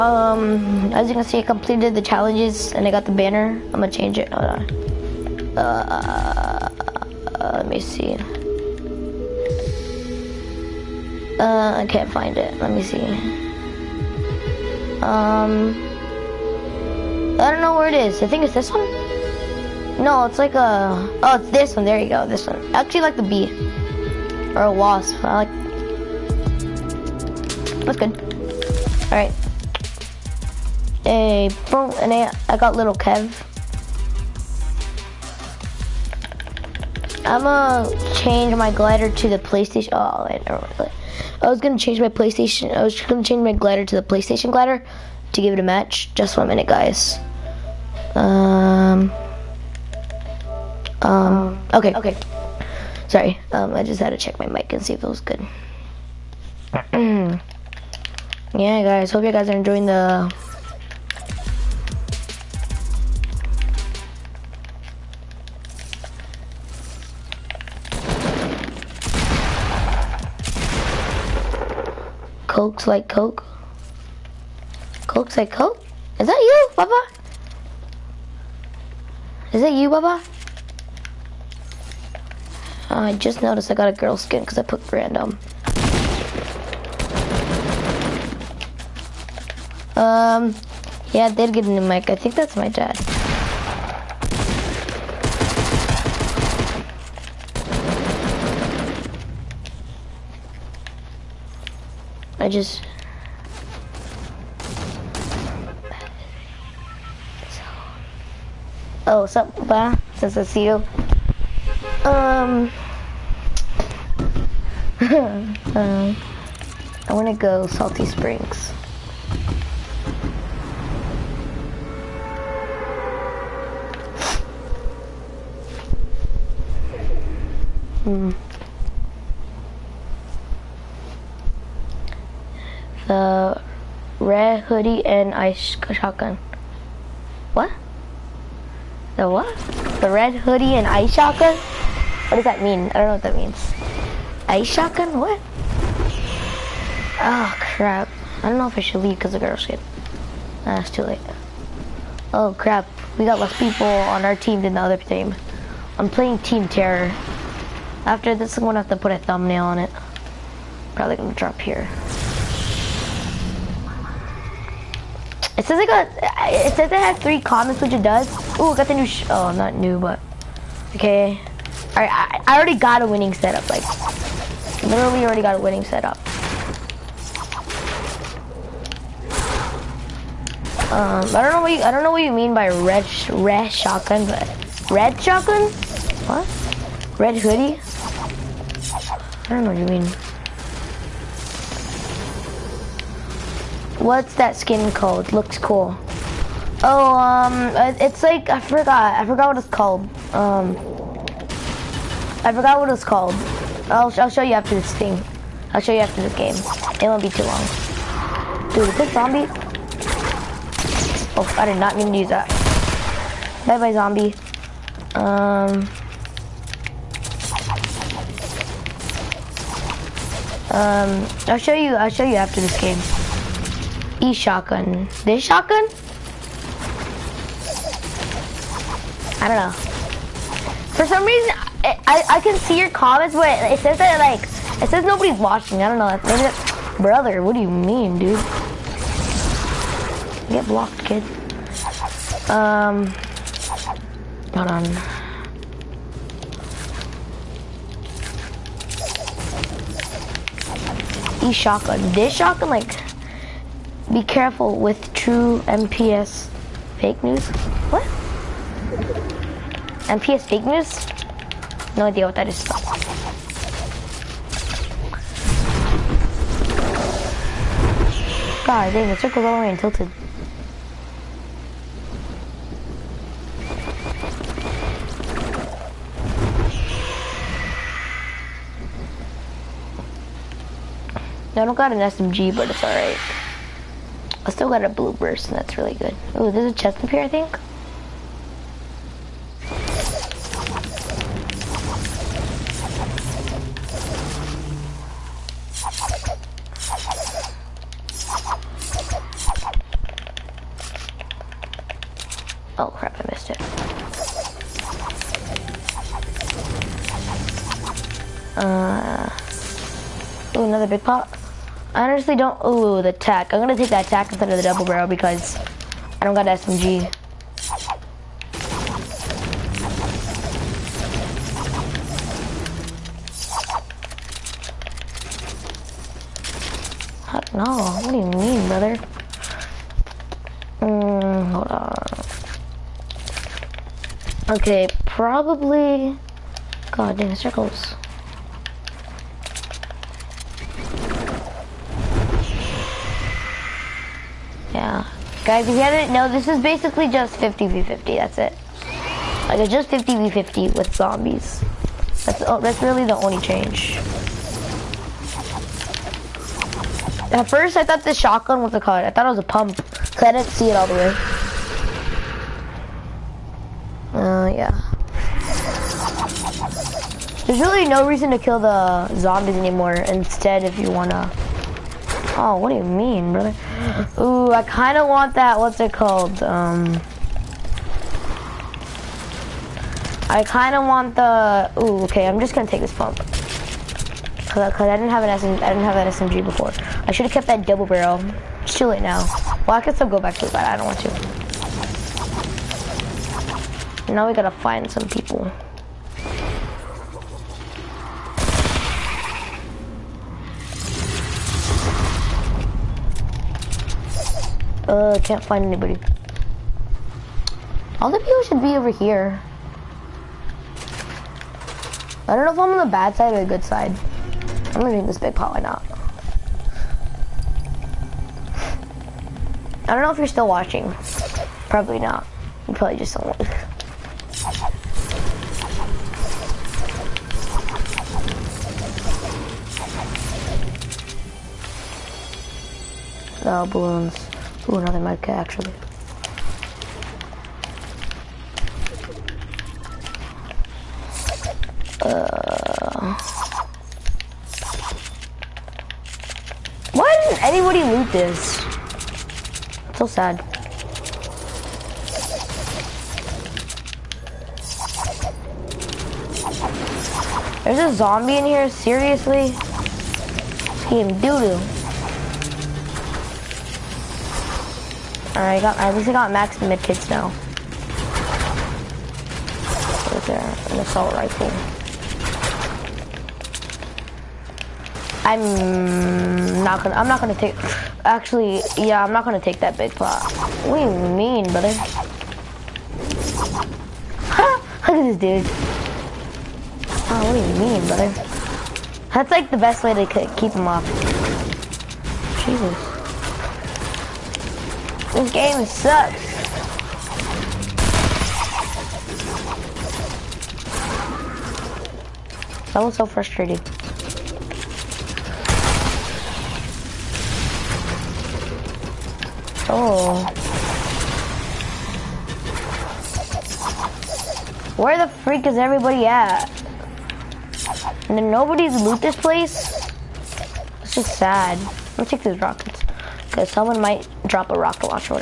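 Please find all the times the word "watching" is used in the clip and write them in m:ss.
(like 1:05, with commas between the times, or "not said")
3:55, 7:00.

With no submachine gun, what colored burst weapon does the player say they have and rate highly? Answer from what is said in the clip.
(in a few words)
blue burst.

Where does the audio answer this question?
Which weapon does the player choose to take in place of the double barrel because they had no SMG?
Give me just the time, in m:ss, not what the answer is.
5:13.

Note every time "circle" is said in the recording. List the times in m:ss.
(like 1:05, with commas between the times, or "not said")
4:29, 5:37.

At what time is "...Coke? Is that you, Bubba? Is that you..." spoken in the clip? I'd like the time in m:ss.
1:15.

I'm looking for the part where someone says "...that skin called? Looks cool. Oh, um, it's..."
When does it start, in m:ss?
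3:14.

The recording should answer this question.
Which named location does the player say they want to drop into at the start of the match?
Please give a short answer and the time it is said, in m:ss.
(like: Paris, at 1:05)
Salty Springs, at 1:57.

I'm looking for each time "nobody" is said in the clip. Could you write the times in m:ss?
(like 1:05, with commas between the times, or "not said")
3:55, 8:38.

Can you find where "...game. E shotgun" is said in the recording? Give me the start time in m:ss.
3:42.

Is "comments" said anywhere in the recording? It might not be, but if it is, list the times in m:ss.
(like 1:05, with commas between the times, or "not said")
2:47, 3:52.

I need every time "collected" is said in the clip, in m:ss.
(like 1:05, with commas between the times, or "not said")
not said.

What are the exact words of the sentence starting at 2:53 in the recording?
Like, literally, already got a winning setup.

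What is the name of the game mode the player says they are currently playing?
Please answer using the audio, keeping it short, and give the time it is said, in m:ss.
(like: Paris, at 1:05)
Team Terror, at 2:36.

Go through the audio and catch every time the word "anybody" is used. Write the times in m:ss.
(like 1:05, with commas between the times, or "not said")
6:45, 7:27.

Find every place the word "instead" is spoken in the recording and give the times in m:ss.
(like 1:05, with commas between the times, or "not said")
5:14, 6:09.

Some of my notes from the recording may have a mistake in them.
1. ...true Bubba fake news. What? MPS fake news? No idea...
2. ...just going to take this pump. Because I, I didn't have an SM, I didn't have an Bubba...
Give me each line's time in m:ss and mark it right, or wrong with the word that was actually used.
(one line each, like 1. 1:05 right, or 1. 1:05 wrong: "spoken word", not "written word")
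1. 4:15 wrong: "MPS", not "Bubba"
2. 6:22 wrong: "SMG", not "Bubba".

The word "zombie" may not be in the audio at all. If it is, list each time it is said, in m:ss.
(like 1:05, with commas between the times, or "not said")
3:29, 3:33, 5:50, 6:09, 7:37.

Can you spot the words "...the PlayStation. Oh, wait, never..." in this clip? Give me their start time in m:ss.
0:39.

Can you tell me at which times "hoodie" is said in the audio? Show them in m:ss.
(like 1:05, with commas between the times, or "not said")
2:14, 2:20, 3:07.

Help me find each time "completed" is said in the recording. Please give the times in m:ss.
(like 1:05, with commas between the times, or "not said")
0:01.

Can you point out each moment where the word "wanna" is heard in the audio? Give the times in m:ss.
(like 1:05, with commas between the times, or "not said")
1:57, 6:10.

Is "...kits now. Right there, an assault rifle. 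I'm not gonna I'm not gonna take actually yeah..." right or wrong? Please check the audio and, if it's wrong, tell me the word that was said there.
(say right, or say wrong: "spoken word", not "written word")
right.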